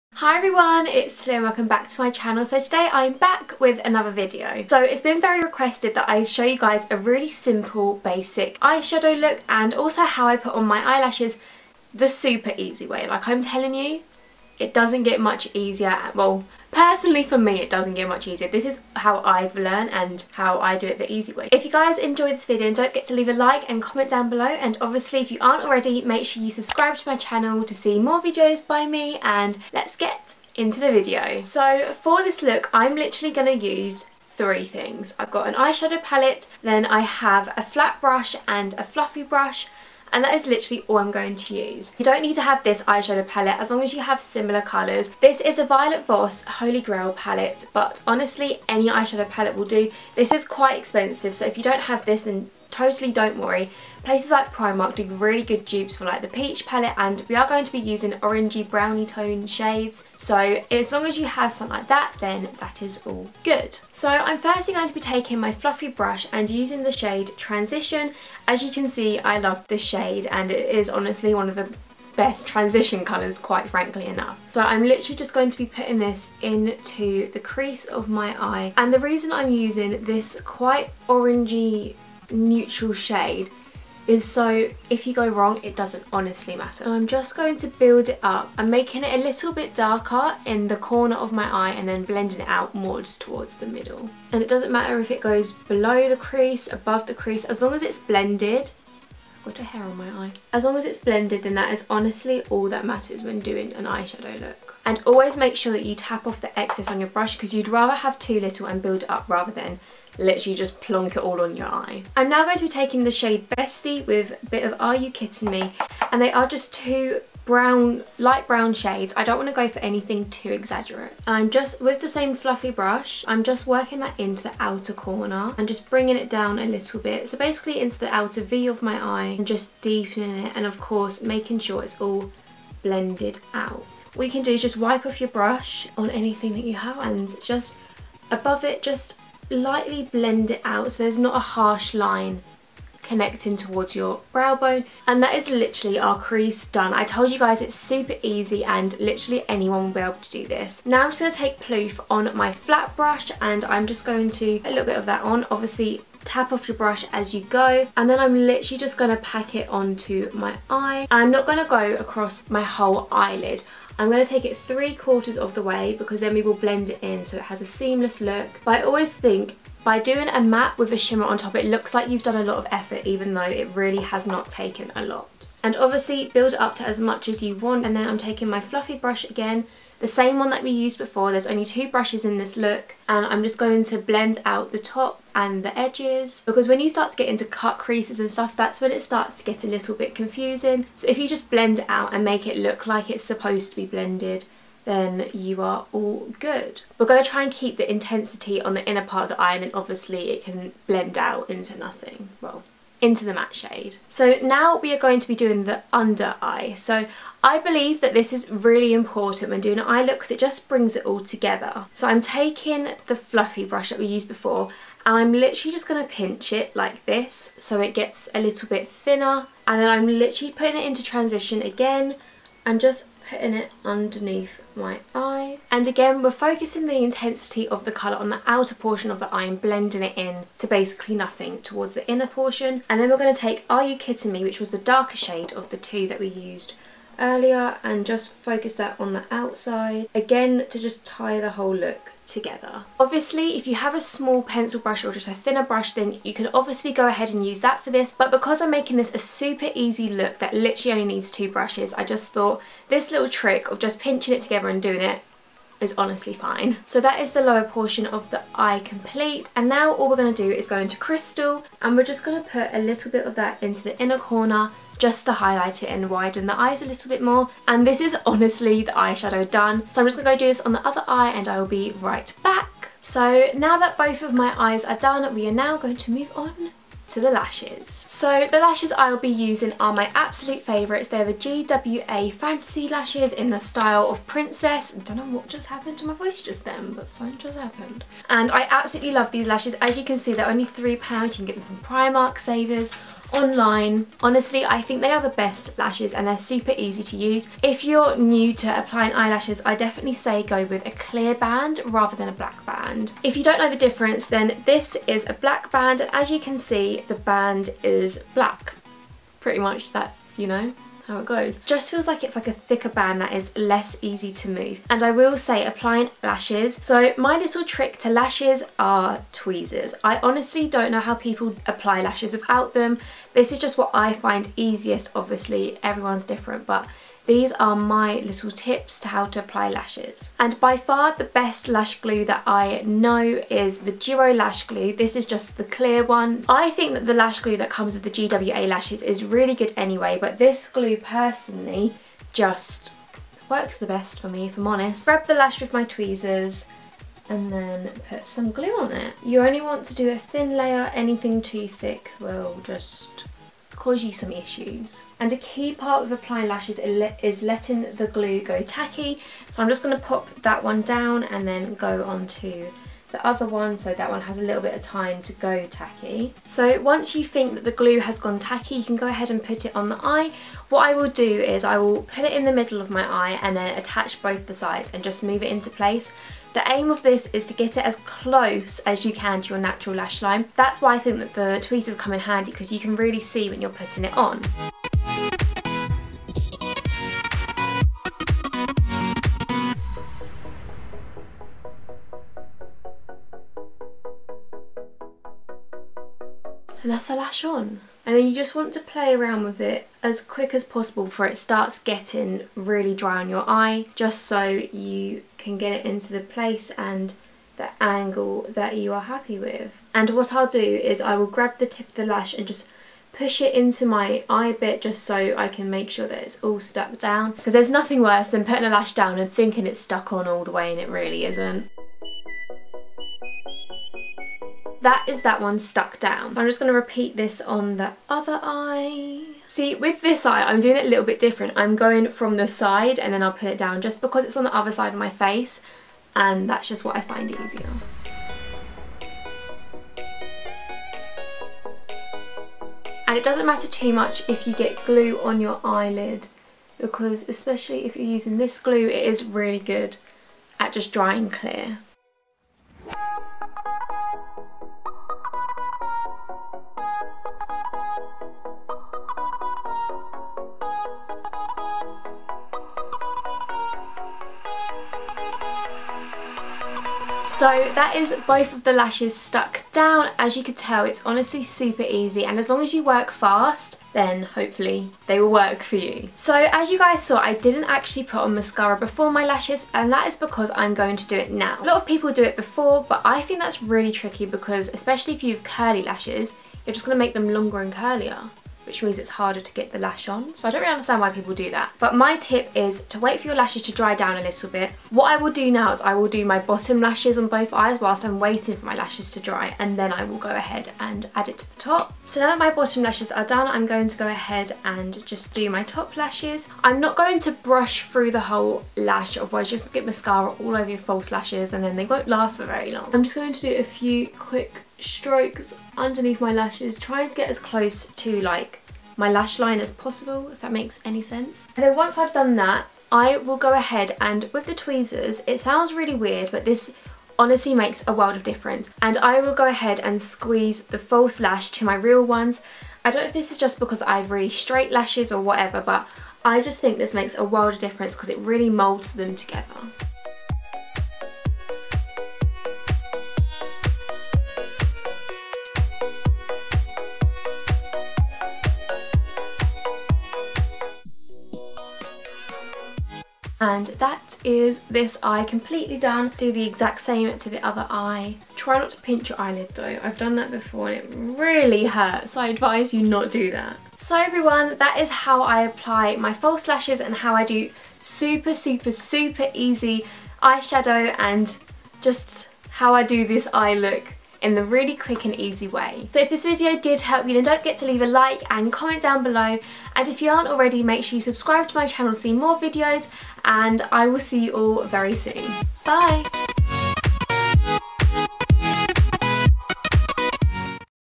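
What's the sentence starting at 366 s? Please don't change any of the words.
So once you think that the glue has gone tacky you can go ahead and put it on the eye.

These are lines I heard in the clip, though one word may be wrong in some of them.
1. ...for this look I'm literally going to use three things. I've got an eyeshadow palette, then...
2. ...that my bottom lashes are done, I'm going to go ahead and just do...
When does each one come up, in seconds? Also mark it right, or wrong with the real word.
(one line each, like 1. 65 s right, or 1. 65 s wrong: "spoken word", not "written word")
1. 31 s right
2. 502 s right.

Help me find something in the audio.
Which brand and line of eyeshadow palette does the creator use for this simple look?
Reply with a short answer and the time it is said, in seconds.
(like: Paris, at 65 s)
Violet Voss Holy Grail, at 45 s.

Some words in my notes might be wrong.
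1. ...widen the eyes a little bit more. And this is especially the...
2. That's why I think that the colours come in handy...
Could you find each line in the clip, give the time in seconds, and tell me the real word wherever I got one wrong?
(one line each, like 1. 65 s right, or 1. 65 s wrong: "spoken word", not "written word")
1. 266 s wrong: "honestly", not "especially"
2. 380 s wrong: "tweezers", not "colours".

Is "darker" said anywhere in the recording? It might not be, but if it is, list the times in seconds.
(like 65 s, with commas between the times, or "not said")
89 s, 234 s.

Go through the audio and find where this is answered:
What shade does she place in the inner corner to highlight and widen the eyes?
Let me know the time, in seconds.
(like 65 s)
260 s.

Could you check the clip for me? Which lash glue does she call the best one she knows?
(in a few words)
Duo Lash Glue.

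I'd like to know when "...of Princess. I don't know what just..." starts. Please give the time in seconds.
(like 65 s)
284 s.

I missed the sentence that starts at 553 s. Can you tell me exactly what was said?
that is this eye completely done.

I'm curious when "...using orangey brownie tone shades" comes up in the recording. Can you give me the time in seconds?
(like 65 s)
57 s.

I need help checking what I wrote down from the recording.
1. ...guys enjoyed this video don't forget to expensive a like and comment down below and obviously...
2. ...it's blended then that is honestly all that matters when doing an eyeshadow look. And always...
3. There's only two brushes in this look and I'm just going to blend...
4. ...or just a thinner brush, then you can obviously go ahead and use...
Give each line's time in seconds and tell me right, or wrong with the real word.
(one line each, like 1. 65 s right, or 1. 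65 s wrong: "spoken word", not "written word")
1. 21 s wrong: "leave", not "expensive"
2. 100 s right
3. 181 s right
4. 245 s right.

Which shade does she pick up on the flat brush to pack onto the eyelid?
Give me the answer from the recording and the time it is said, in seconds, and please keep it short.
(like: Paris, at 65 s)
Ploof, at 151 s.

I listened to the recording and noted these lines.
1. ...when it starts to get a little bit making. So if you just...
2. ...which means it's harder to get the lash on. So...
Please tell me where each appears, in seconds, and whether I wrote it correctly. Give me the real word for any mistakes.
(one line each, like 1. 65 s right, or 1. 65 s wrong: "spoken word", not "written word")
1. 188 s wrong: "confusing", not "making"
2. 488 s right.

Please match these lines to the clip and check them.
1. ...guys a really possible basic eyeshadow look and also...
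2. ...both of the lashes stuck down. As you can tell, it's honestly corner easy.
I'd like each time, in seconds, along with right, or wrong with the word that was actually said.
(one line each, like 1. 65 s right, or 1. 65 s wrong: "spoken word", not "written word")
1. 6 s wrong: "simple", not "possible"
2. 468 s wrong: "super", not "corner".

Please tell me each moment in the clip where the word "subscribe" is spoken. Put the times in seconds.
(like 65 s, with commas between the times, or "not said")
26 s, 581 s.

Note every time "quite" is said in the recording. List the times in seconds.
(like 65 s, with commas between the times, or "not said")
50 s, 73 s, 80 s.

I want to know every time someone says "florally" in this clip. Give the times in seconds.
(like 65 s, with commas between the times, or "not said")
not said.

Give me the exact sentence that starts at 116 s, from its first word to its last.
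And they are just two brown, light brown shades.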